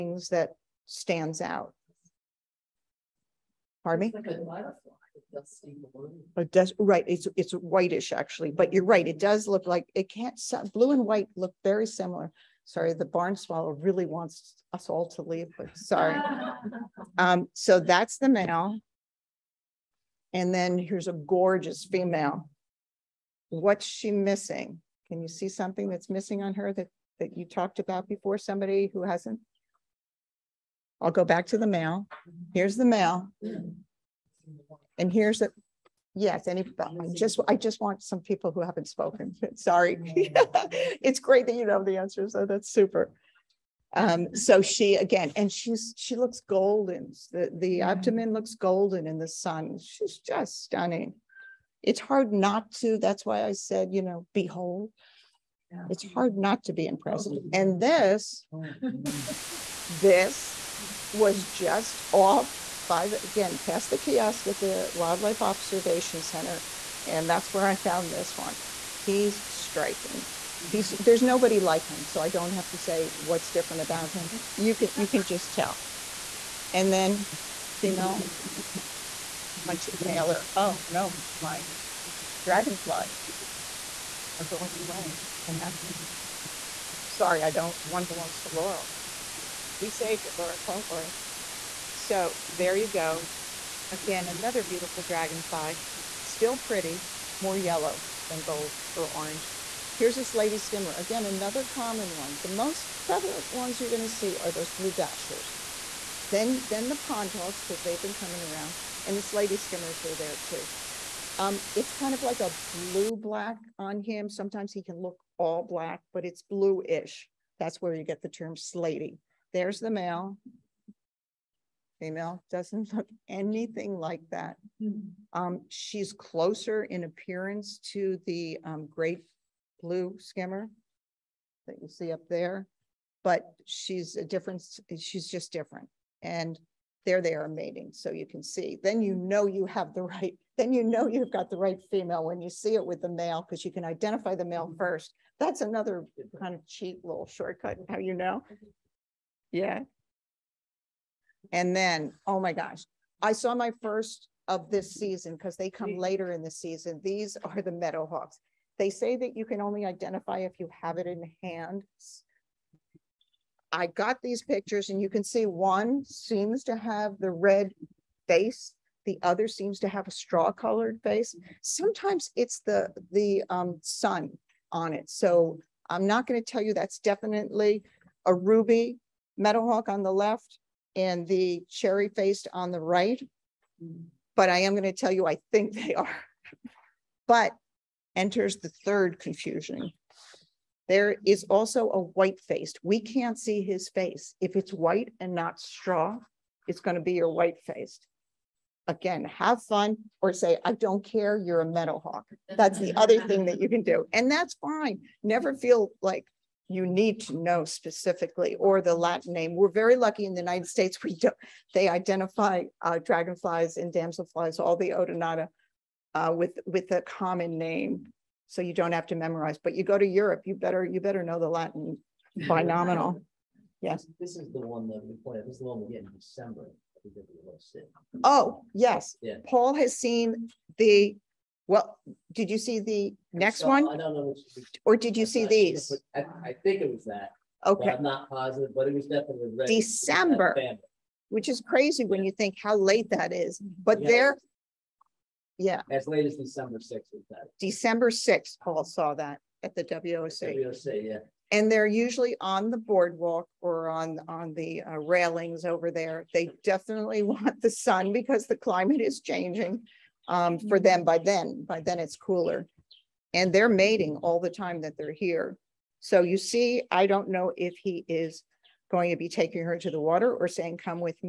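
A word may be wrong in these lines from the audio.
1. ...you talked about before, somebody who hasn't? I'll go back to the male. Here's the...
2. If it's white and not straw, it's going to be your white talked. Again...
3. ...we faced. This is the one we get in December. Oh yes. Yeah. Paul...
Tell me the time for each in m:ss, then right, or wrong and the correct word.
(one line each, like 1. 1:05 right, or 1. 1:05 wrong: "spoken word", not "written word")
1. 0:27 right
2. 3:14 wrong: "faced", not "talked"
3. 3:45 wrong: "played", not "faced".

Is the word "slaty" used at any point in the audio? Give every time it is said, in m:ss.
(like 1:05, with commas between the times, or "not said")
1:49, 1:58.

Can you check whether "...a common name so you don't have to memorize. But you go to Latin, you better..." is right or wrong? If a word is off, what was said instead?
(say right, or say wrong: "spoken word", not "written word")
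wrong: "Europe", not "Latin".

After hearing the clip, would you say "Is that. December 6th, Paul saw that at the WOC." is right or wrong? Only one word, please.
right.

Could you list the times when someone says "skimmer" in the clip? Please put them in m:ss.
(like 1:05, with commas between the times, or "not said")
1:40, 1:49, 2:10.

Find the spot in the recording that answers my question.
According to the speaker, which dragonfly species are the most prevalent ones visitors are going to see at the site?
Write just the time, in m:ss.
1:44.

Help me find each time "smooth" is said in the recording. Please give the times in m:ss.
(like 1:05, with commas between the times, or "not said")
not said.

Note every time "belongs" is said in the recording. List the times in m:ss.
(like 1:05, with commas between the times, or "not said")
1:28.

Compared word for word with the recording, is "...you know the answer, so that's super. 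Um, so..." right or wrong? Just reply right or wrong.
right.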